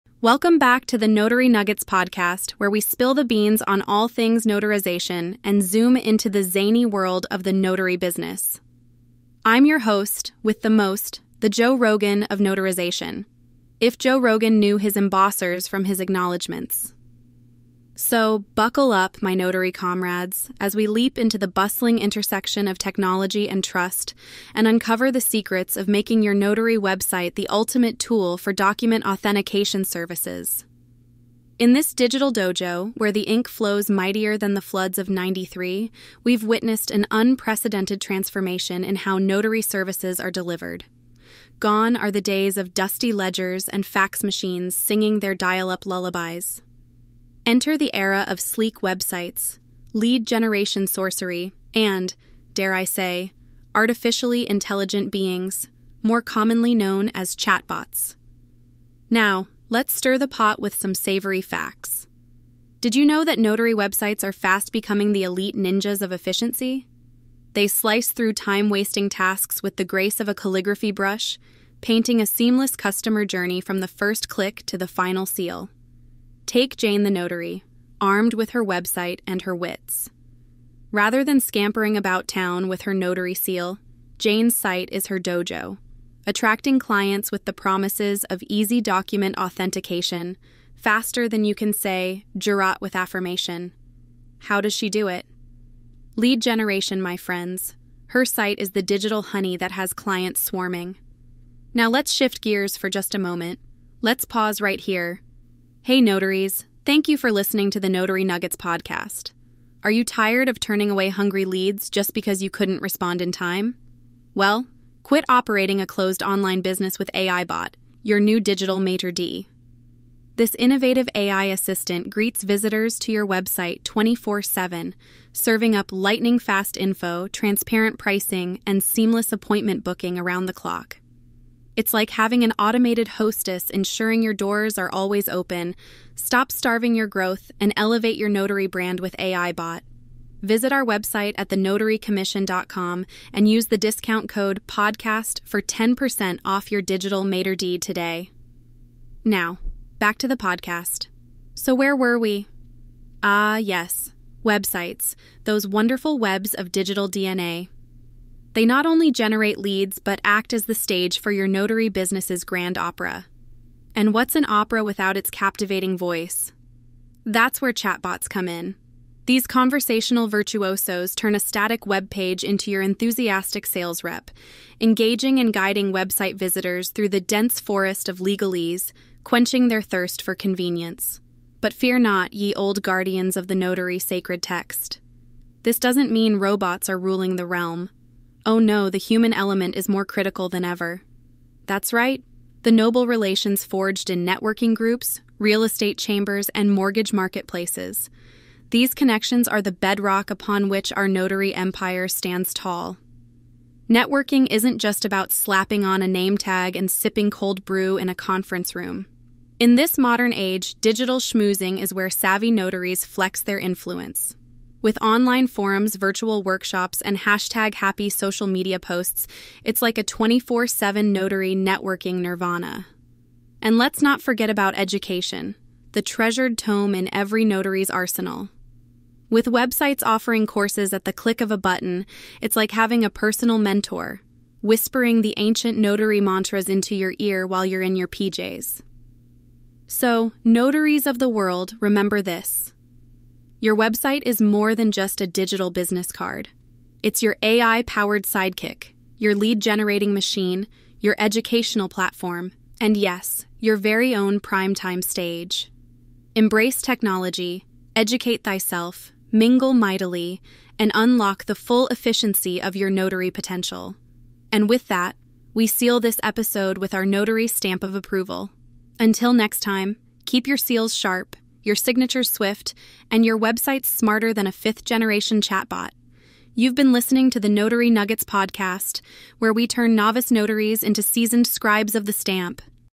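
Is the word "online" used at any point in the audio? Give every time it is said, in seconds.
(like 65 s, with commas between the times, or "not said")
116 s, 215 s.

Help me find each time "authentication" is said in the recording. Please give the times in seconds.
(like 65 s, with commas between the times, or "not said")
29 s, 89 s.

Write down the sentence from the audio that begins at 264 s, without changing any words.
And with that, we seal this episode with our notary stamp of approval.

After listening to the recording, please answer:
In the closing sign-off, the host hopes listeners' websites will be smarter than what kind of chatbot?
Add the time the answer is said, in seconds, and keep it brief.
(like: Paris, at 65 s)
fifth generation chatbot, at 274 s.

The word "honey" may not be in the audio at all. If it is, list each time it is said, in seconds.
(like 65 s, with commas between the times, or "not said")
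99 s.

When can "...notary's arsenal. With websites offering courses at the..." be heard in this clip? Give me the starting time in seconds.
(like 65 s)
227 s.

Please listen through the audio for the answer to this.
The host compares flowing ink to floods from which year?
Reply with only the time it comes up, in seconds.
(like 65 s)
35 s.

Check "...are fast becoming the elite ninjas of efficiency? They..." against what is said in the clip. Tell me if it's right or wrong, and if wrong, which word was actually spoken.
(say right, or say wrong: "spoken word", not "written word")
right.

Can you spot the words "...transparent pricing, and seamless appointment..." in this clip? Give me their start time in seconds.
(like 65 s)
127 s.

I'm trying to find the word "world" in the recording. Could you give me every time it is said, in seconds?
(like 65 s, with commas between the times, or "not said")
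6 s, 241 s.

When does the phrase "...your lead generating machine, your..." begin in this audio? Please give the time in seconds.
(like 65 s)
249 s.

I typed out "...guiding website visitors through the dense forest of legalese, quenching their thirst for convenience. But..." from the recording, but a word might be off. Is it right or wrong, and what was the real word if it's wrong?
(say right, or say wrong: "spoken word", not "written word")
right.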